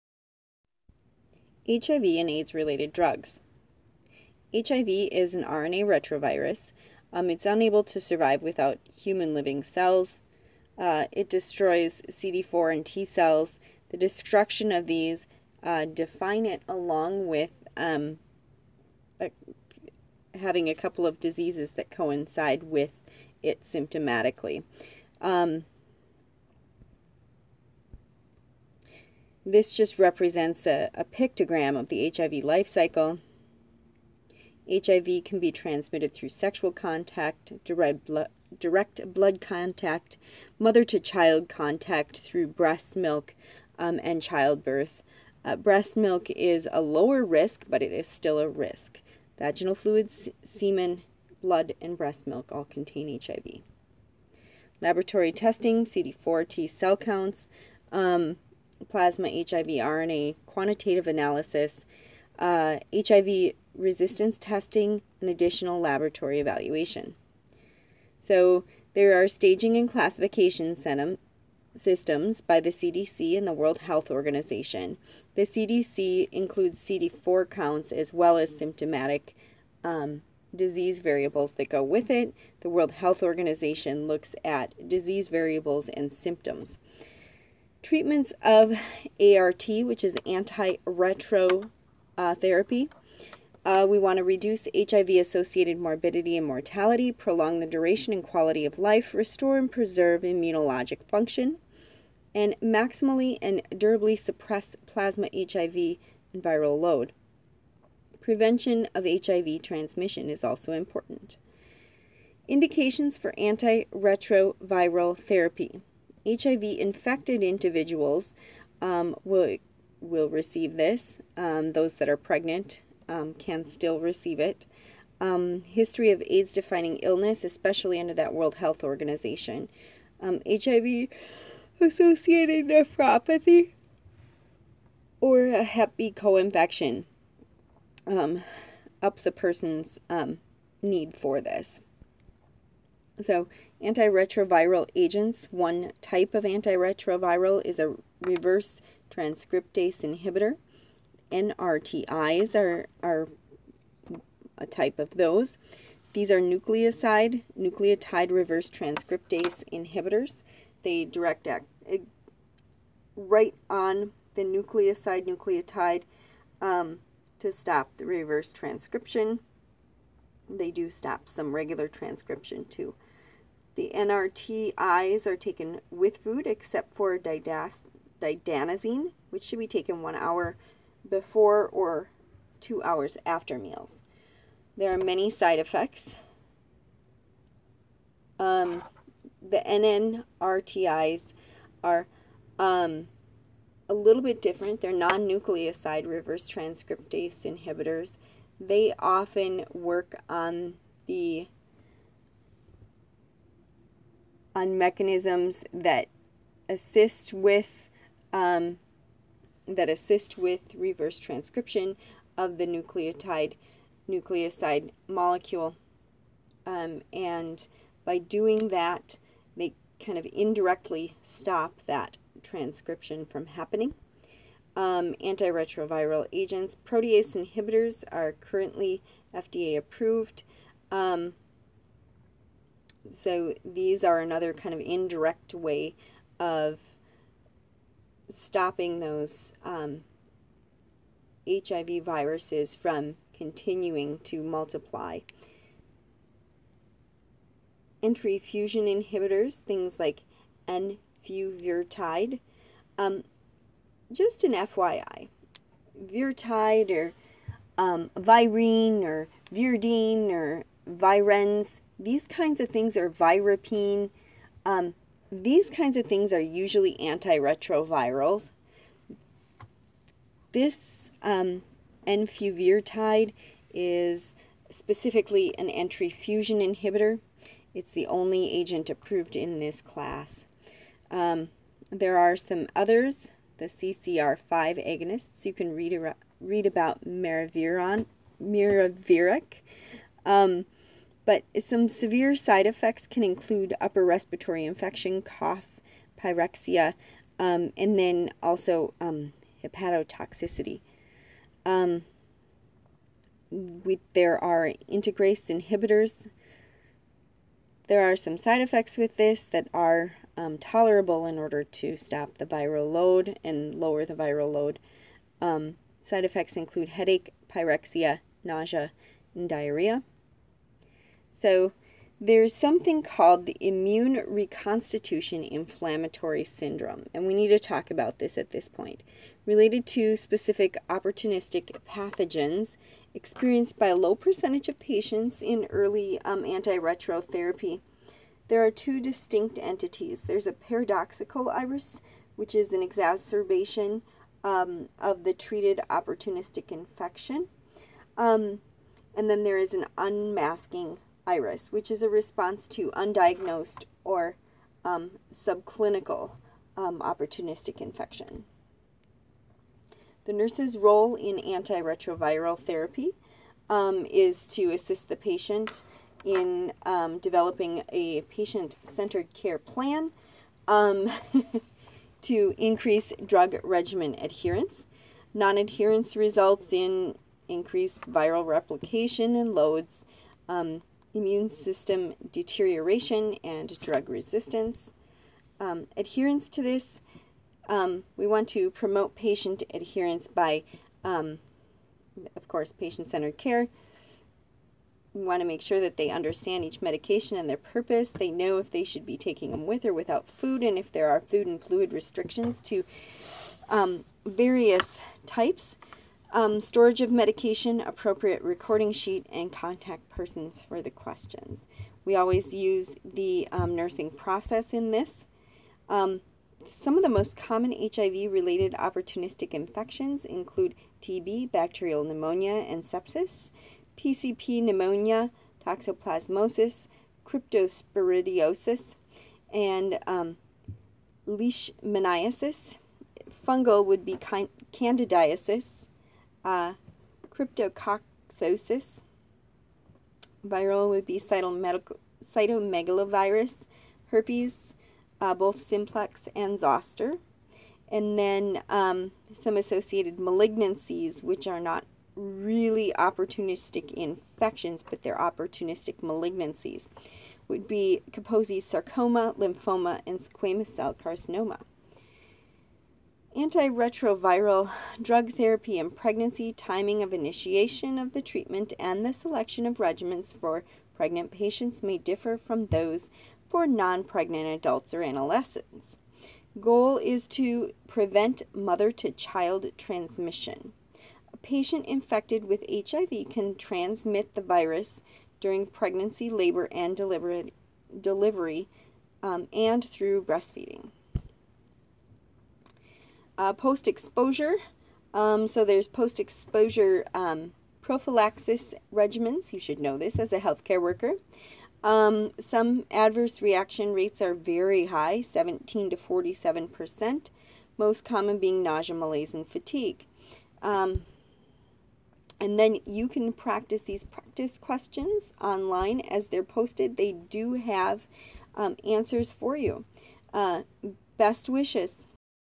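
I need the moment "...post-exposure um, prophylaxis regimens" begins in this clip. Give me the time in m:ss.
8:15.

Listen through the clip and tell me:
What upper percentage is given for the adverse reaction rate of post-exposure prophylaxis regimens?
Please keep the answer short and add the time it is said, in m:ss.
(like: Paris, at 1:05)
47 percent, at 8:25.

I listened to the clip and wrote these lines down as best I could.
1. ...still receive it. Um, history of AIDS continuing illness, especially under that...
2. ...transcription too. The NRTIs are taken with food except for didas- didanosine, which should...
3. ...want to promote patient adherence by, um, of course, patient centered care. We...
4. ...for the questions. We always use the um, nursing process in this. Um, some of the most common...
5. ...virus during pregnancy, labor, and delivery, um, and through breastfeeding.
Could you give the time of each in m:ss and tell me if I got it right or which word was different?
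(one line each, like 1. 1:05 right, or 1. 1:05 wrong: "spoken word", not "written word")
1. 2:03 wrong: "defining", not "continuing"
2. 2:51 right
3. 6:28 right
4. 6:50 right
5. 8:04 right.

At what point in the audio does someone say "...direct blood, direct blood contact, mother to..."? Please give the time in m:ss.
0:37.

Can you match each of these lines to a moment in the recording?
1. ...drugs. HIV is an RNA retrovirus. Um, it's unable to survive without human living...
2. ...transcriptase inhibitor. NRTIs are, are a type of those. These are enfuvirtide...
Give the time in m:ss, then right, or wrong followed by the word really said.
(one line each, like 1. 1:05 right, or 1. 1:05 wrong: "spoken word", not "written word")
1. 0:02 right
2. 2:29 wrong: "nucleoside", not "enfuvirtide".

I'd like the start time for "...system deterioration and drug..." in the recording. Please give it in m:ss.
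6:21.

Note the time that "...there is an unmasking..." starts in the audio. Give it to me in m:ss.
5:49.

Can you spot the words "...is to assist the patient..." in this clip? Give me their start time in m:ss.
6:04.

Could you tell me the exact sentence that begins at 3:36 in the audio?
Um, and by doing that, they kind of indirectly stop that transcription from happening.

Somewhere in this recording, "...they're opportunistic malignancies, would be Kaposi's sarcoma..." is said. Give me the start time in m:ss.
7:35.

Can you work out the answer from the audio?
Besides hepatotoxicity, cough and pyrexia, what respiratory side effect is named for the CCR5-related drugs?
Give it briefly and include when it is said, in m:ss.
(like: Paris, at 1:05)
upper respiratory infection, at 4:53.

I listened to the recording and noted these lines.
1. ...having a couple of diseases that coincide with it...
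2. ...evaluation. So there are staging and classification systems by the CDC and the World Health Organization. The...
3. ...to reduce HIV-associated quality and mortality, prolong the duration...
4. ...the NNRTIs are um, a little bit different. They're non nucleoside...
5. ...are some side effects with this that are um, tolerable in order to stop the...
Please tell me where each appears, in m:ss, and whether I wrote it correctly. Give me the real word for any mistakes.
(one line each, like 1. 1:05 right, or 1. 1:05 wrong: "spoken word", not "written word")
1. 0:20 right
2. 1:06 right
3. 1:34 wrong: "morbidity", not "quality"
4. 3:09 right
5. 5:08 right.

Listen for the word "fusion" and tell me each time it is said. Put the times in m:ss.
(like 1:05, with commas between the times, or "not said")
4:08, 4:36.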